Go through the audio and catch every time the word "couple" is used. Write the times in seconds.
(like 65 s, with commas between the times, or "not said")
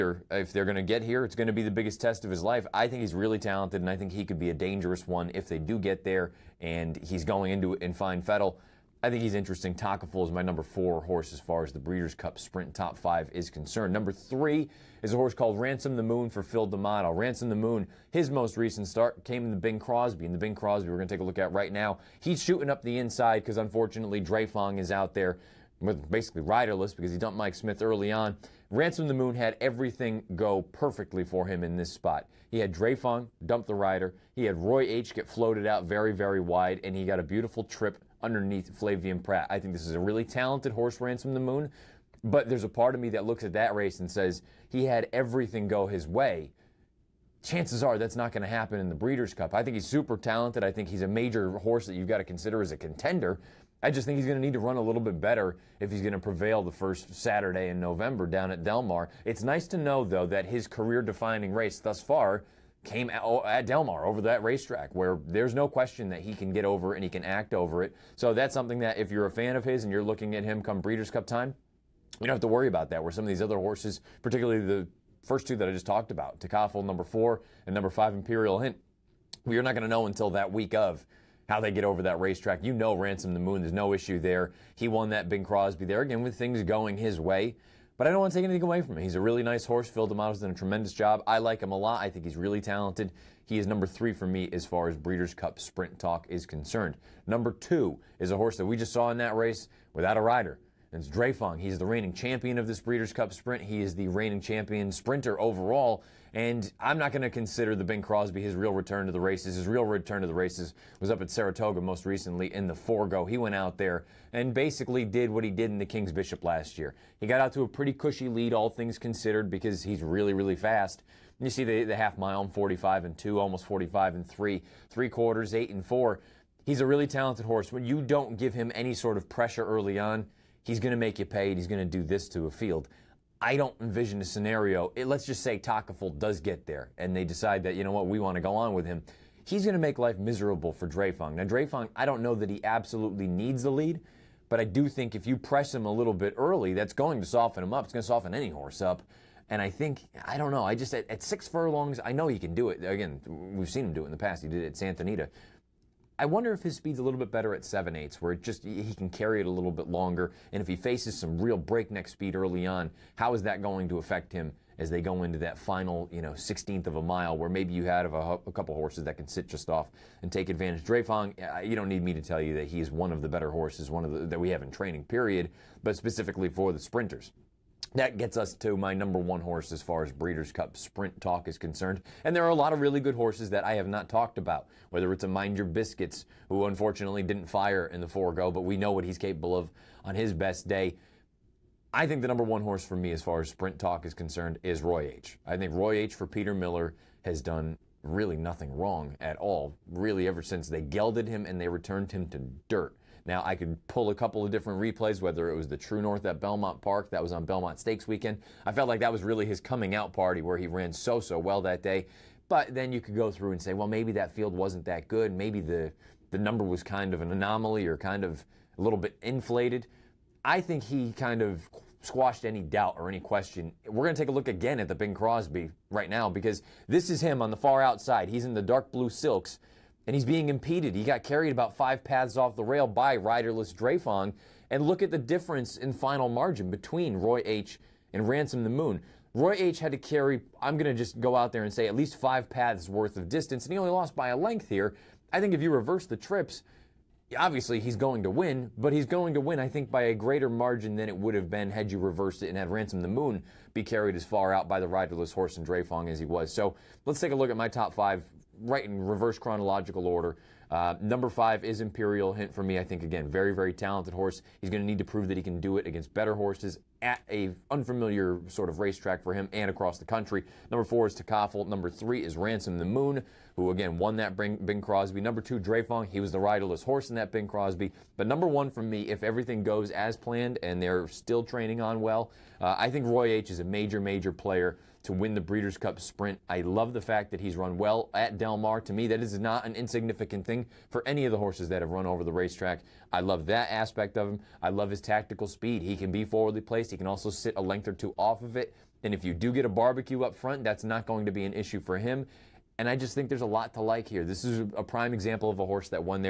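168 s, 204 s.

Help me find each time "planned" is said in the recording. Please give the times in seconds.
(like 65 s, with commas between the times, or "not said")
280 s.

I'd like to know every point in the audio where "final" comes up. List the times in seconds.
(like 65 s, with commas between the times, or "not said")
165 s, 235 s.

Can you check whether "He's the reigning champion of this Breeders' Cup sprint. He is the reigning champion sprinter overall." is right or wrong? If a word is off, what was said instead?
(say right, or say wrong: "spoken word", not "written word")
right.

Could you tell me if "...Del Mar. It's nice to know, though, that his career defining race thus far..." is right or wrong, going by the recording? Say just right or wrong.
right.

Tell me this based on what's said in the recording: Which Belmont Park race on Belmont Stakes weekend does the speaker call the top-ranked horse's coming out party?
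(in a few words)
True North.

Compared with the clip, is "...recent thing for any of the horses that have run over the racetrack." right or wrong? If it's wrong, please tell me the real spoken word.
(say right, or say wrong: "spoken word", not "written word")
wrong: "insignificant", not "recent".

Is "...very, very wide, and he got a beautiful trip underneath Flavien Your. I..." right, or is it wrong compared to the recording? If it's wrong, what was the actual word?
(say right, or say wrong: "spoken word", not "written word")
wrong: "Prat", not "Your".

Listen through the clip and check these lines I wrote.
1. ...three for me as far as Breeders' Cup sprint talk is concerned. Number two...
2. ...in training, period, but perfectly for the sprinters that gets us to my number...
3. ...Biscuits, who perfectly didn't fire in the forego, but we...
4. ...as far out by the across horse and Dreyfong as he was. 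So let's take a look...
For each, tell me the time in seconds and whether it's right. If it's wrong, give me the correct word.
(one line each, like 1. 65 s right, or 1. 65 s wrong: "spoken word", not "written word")
1. 93 s right
2. 174 s wrong: "specifically", not "perfectly"
3. 185 s wrong: "unfortunately", not "perfectly"
4. 254 s wrong: "riderless", not "across".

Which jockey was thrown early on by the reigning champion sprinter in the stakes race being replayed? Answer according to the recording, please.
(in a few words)
Mike Smith.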